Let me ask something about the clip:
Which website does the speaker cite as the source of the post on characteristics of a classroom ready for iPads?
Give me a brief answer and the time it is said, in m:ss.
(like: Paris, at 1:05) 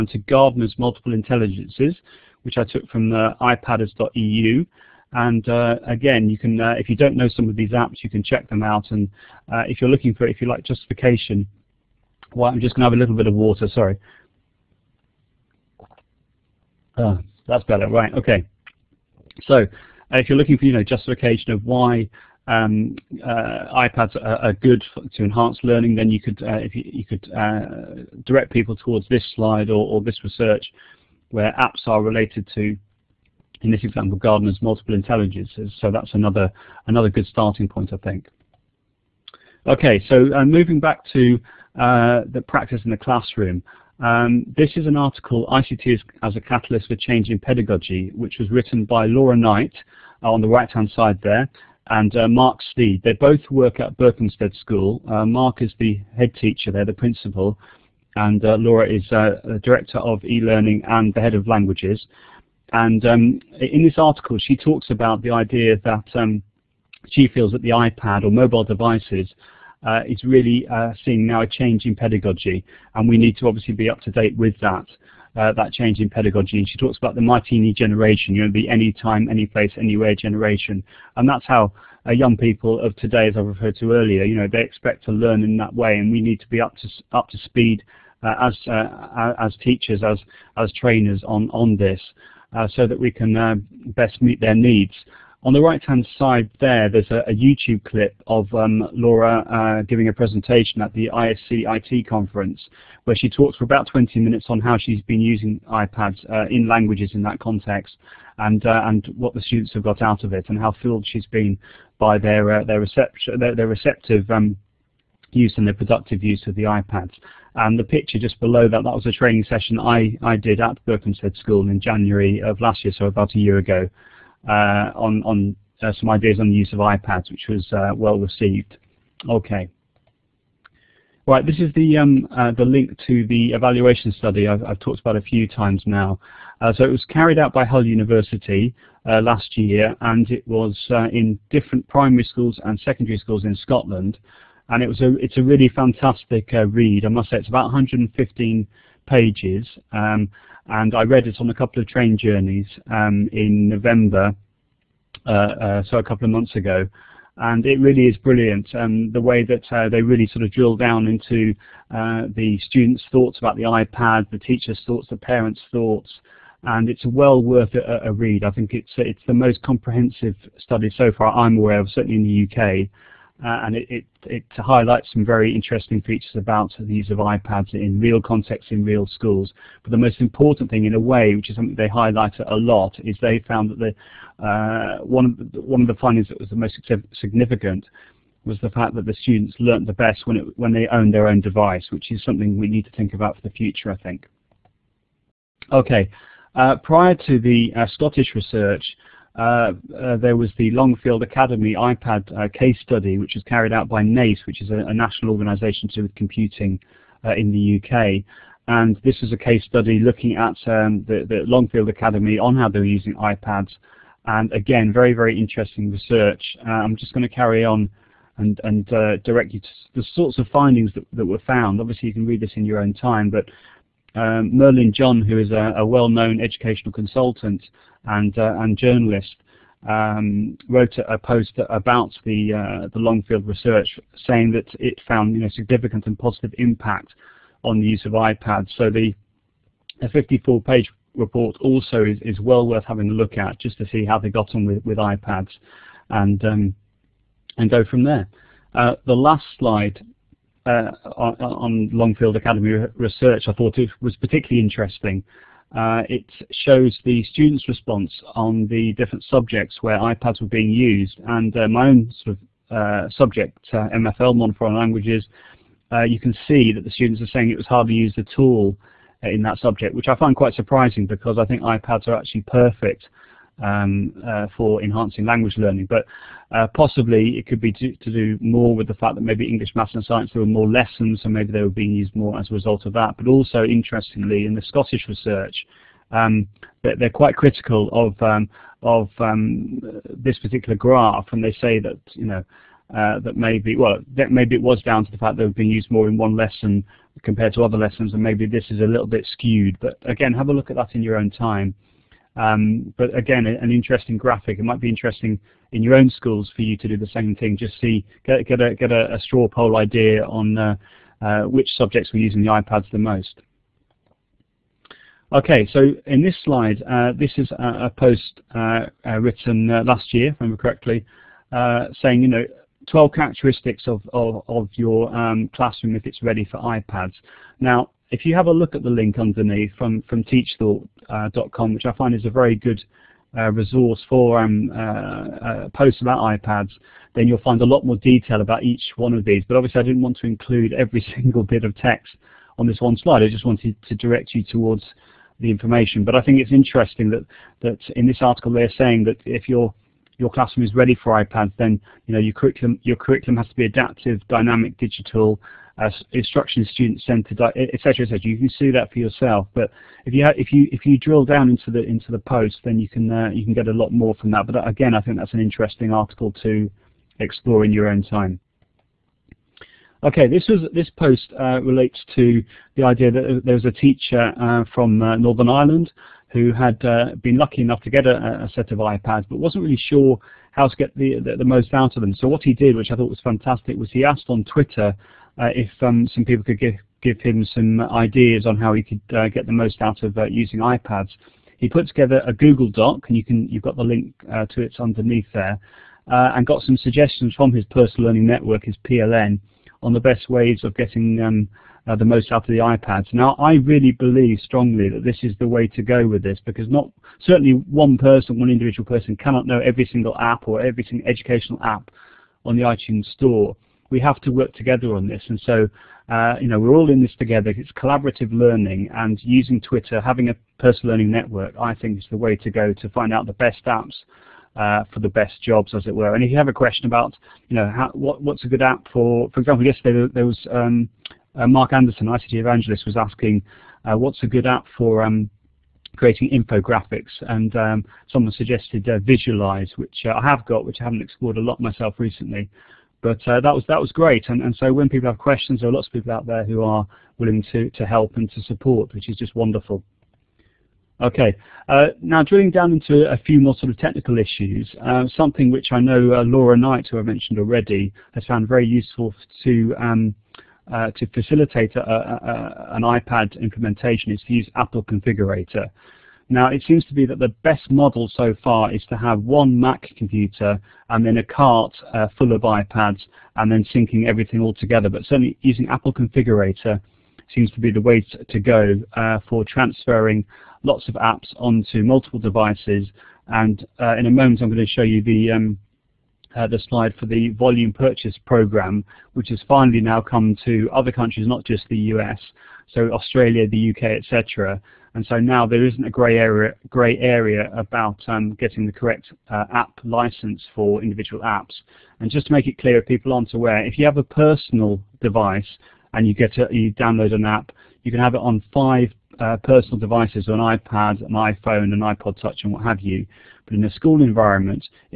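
teachthought.com, at 5:30.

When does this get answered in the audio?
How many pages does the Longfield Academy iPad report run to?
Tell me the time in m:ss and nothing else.
4:00.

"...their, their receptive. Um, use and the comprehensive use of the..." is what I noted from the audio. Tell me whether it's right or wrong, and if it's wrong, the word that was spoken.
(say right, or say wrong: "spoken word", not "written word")
wrong: "productive", not "comprehensive".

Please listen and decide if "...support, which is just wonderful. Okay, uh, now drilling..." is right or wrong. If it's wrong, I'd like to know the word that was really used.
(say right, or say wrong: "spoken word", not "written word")
right.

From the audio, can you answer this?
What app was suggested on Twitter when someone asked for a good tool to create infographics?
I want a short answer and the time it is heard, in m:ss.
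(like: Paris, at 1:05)
Visualize, at 7:18.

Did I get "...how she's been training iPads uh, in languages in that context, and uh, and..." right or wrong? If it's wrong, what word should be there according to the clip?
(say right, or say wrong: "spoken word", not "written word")
wrong: "using", not "training".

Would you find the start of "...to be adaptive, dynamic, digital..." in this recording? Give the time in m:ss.
5:53.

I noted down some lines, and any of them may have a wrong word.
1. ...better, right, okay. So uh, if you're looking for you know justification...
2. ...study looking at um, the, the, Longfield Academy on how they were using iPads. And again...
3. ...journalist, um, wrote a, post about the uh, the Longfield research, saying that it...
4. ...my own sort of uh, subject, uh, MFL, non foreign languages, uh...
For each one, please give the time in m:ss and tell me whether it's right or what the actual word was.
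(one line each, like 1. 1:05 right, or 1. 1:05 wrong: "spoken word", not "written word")
1. 0:17 right
2. 3:29 right
3. 3:48 right
4. 4:21 right.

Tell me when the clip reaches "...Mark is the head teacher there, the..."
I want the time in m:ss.
0:55.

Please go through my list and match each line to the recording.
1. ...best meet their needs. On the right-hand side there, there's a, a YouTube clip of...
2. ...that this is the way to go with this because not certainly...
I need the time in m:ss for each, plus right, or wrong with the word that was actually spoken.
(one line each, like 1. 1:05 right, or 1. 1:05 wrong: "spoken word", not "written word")
1. 1:33 right
2. 6:44 right.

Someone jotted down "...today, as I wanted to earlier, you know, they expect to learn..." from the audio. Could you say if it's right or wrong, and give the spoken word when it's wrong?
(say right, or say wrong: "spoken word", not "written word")
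wrong: "referred", not "wanted".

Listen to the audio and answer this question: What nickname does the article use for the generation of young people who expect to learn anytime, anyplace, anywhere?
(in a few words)
Martini generation.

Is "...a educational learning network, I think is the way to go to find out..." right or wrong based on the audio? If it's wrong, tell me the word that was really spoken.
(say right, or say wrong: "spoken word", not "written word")
wrong: "personal", not "educational".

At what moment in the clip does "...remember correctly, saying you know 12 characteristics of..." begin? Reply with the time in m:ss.
5:20.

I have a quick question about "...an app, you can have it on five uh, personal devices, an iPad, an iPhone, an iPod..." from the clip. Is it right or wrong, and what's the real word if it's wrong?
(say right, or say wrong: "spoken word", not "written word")
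right.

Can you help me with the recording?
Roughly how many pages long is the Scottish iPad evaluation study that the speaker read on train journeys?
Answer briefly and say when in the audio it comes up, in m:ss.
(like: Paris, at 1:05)
115, at 2:27.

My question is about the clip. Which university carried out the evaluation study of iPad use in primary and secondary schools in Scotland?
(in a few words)
Hull University.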